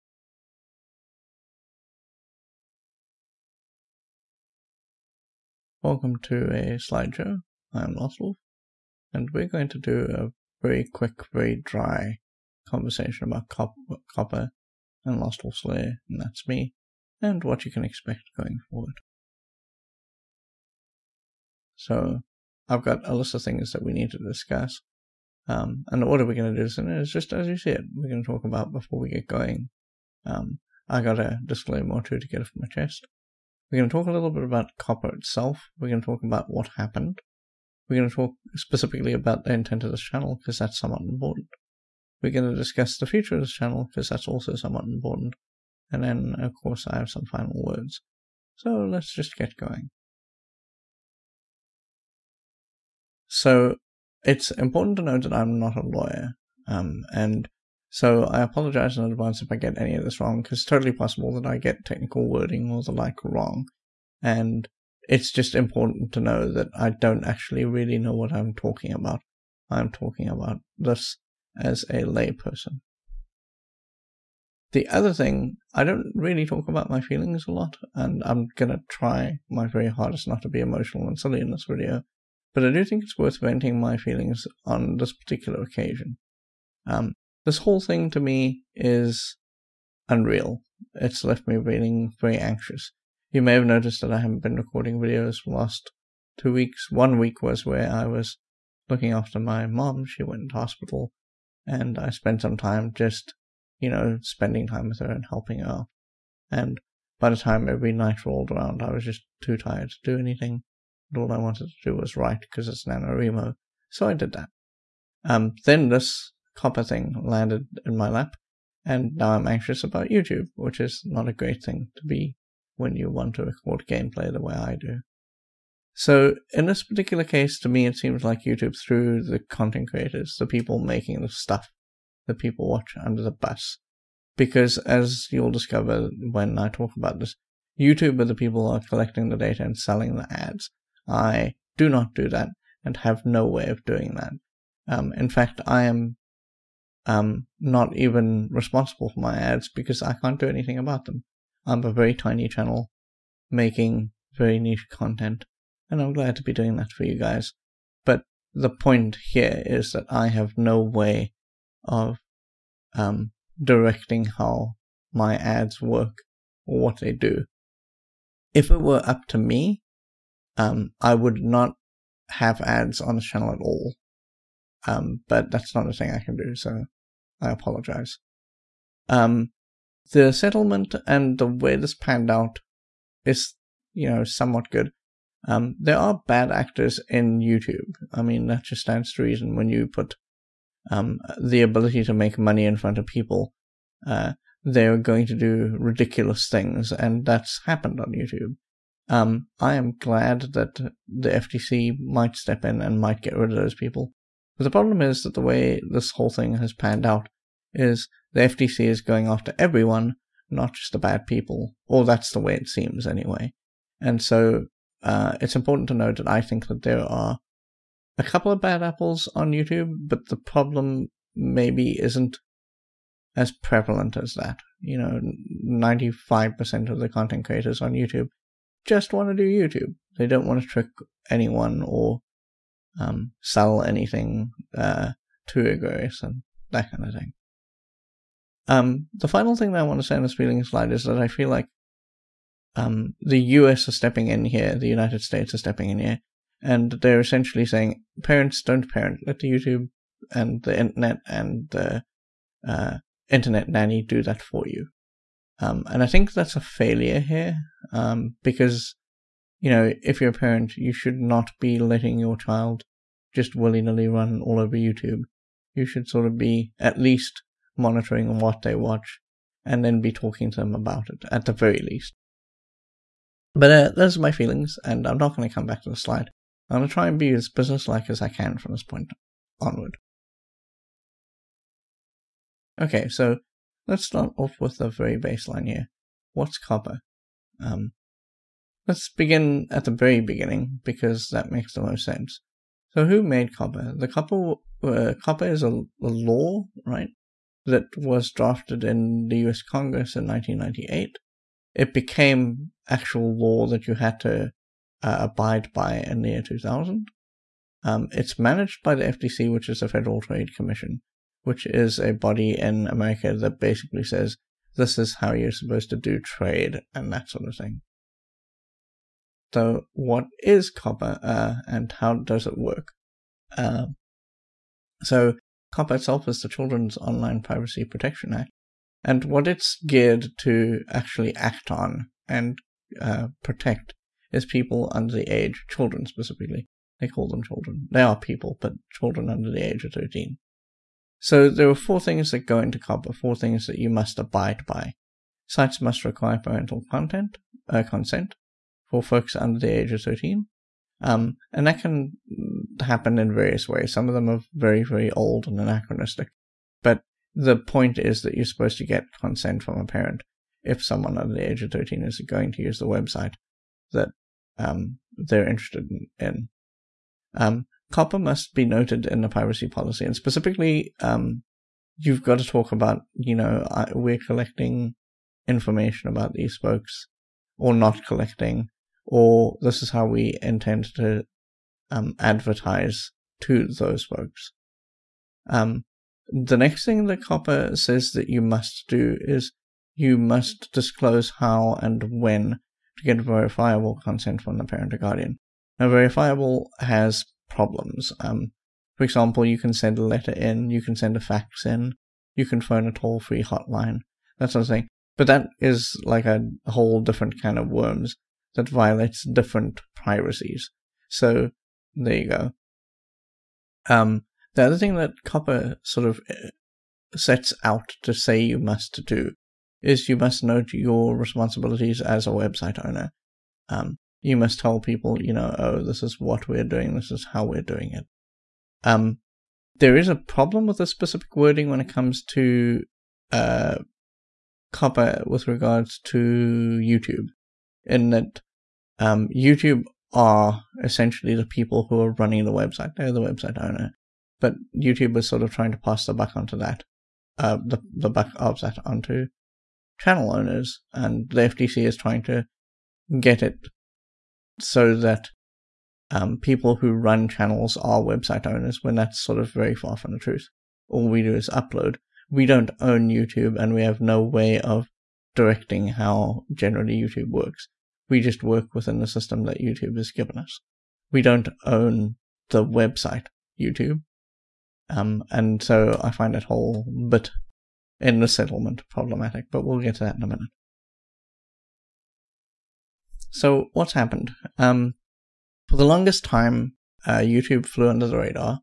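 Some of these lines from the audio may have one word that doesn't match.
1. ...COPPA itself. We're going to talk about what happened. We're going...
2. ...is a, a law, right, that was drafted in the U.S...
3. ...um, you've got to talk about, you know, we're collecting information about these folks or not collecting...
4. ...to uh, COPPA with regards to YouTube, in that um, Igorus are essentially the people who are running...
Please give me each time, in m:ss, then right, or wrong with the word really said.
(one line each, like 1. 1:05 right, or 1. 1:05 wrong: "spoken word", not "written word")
1. 0:34 right
2. 4:55 right
3. 6:10 right
4. 7:12 wrong: "YouTube", not "Igorus".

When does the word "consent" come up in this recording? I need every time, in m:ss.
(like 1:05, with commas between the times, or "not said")
5:47, 5:59, 6:34.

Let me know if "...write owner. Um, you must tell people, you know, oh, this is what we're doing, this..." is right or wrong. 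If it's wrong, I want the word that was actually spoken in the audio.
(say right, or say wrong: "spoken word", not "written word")
wrong: "website", not "write".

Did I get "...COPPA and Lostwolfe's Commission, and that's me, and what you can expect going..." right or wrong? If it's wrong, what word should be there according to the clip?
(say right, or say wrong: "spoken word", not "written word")
wrong: "Lair", not "Commission".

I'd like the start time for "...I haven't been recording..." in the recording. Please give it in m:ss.
1:34.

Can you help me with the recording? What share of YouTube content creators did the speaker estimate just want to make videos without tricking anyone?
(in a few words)
95%.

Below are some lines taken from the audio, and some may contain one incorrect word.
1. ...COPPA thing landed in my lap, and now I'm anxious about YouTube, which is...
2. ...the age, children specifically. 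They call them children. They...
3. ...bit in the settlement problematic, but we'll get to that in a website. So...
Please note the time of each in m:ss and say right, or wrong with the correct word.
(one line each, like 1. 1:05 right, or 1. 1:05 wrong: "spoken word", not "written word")
1. 1:56 right
2. 5:35 right
3. 7:57 wrong: "minute", not "website".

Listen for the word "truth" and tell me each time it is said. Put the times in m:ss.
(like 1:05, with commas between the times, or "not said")
7:40.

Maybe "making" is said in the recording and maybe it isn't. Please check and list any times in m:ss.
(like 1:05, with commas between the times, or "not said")
2:10, 2:33.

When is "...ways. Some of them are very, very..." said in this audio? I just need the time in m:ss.
5:53.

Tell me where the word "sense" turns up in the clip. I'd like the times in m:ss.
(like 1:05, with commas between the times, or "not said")
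4:52.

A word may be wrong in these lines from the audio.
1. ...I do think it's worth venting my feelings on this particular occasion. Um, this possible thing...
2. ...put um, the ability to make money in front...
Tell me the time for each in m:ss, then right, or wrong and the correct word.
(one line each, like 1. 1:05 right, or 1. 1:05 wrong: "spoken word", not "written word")
1. 1:22 wrong: "whole", not "possible"
2. 3:09 right.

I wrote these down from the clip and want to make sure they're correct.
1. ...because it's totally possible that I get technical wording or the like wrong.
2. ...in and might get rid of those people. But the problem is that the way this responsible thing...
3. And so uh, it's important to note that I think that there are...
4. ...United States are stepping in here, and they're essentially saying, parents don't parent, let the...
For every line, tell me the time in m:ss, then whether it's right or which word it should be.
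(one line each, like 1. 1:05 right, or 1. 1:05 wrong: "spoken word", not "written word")
1. 1:00 right
2. 3:22 wrong: "whole", not "responsible"
3. 3:34 right
4. 4:04 right.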